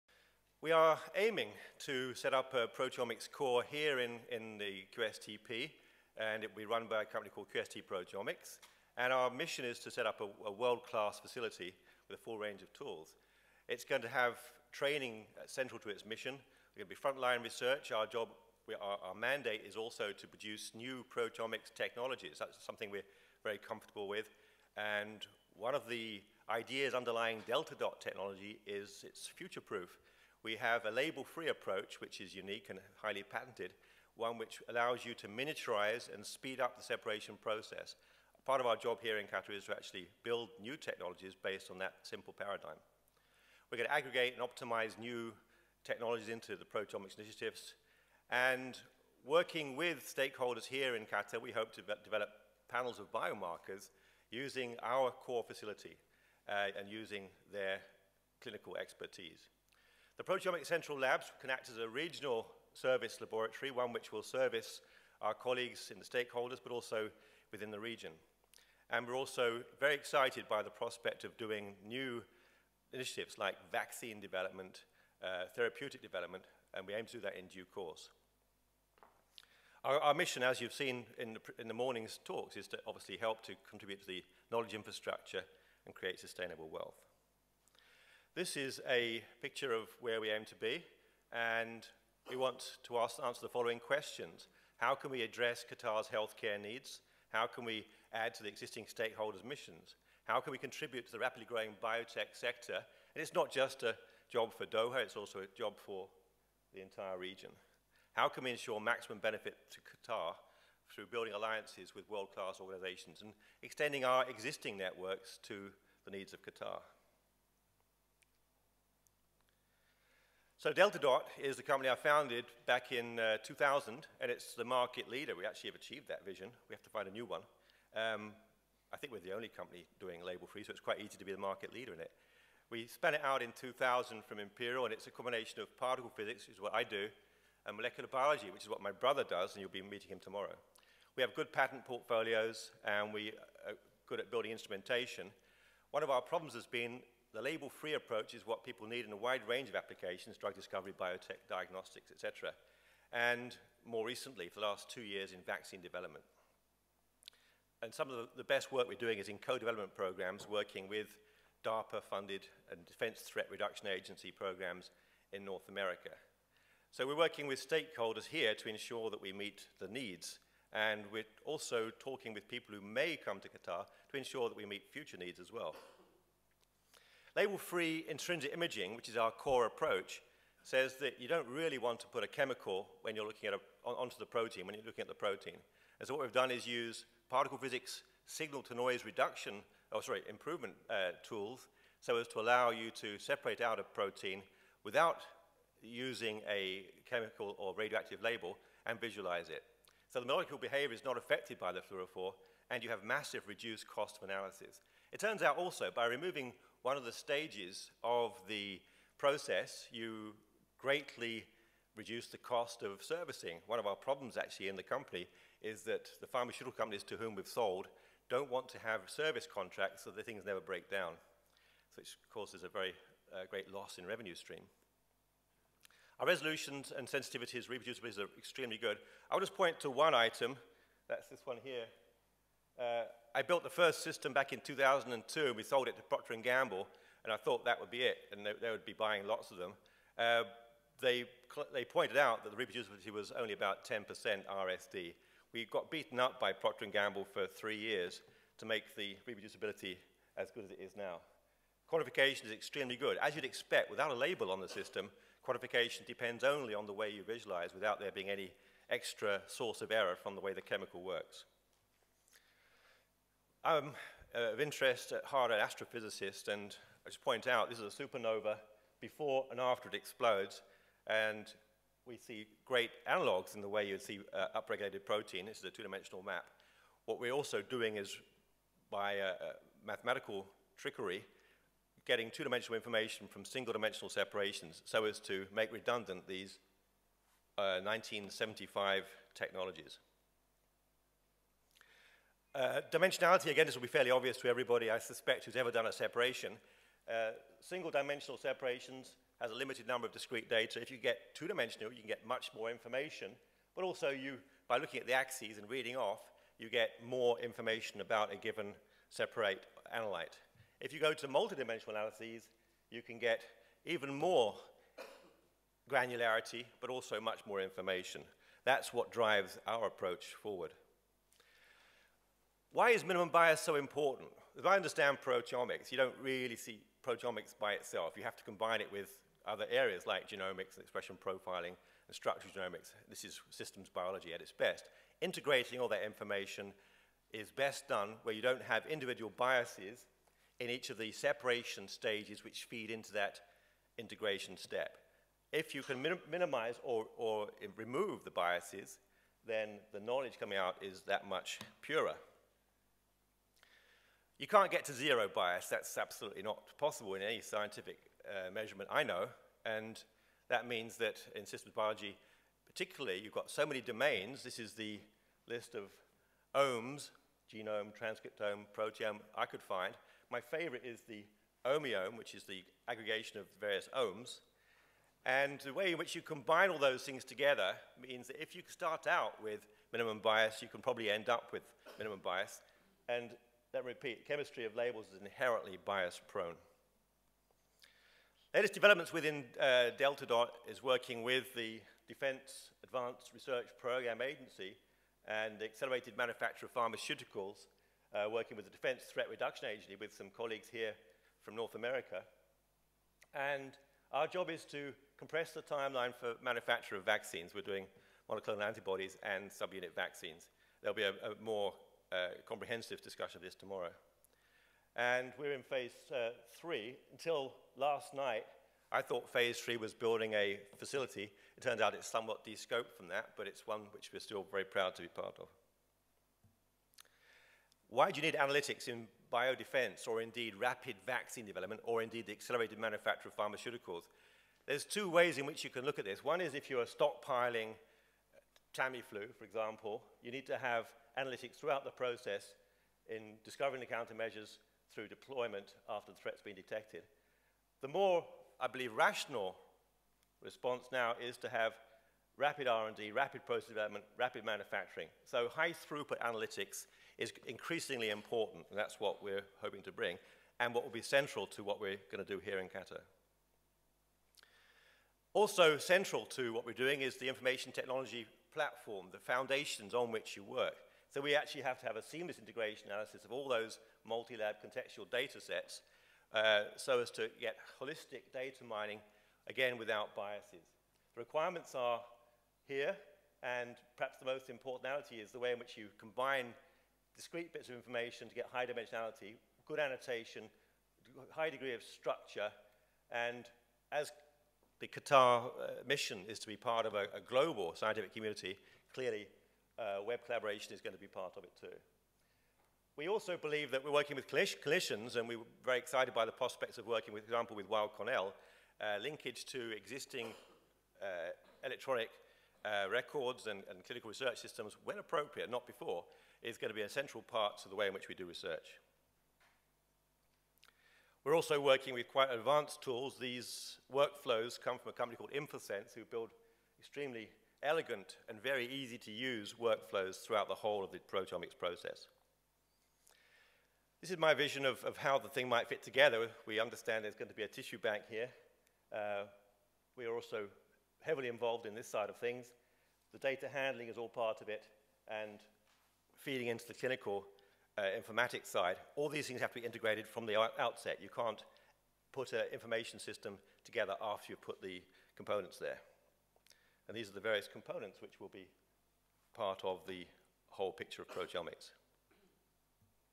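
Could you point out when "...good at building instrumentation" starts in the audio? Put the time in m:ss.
2:24.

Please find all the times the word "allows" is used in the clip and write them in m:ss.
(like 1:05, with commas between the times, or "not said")
0:34, 3:12.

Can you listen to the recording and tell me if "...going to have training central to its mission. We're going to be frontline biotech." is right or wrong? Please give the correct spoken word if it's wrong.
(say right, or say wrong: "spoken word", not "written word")
wrong: "research", not "biotech".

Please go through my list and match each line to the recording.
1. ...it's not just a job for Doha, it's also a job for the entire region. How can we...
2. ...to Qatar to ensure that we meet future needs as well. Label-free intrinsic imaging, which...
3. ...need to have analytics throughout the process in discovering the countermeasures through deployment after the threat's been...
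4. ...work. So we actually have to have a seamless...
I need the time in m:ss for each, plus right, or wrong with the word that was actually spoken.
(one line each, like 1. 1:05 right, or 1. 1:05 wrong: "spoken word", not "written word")
1. 1:43 right
2. 2:53 right
3. 7:20 right
4. 7:50 right.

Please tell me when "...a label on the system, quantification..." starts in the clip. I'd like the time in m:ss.
4:14.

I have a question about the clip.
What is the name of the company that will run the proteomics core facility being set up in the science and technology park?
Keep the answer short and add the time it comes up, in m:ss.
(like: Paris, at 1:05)
QST Proteomics, at 0:07.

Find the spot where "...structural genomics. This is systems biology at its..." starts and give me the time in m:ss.
5:32.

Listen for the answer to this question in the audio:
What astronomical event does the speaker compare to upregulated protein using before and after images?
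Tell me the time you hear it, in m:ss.
4:28.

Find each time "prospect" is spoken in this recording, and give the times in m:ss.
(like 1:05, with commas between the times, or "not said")
1:10, 8:26.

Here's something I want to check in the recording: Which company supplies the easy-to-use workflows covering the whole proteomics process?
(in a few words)
InforSense.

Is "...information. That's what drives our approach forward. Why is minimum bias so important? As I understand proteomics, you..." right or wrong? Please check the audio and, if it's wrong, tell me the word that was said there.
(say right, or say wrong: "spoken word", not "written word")
right.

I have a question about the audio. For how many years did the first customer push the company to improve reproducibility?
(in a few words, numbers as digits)
3.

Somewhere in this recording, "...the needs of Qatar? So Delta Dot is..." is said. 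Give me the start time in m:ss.
1:56.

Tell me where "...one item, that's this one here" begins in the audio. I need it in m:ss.
3:49.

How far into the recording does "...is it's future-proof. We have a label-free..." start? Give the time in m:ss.
0:28.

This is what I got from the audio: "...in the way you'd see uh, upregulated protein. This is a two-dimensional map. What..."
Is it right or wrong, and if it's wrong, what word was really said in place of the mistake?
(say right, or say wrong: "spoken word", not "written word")
right.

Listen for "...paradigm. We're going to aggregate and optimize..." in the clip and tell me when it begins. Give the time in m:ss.
0:42.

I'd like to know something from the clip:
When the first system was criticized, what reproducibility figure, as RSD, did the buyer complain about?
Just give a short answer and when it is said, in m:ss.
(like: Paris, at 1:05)
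10%, at 4:03.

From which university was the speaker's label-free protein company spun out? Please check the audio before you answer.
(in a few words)
Imperial.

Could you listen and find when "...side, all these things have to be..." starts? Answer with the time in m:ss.
9:08.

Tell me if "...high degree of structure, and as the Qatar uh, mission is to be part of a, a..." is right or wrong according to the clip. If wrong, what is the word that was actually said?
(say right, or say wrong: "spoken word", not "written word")
right.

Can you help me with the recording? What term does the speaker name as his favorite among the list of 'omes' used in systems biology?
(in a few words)
omiome.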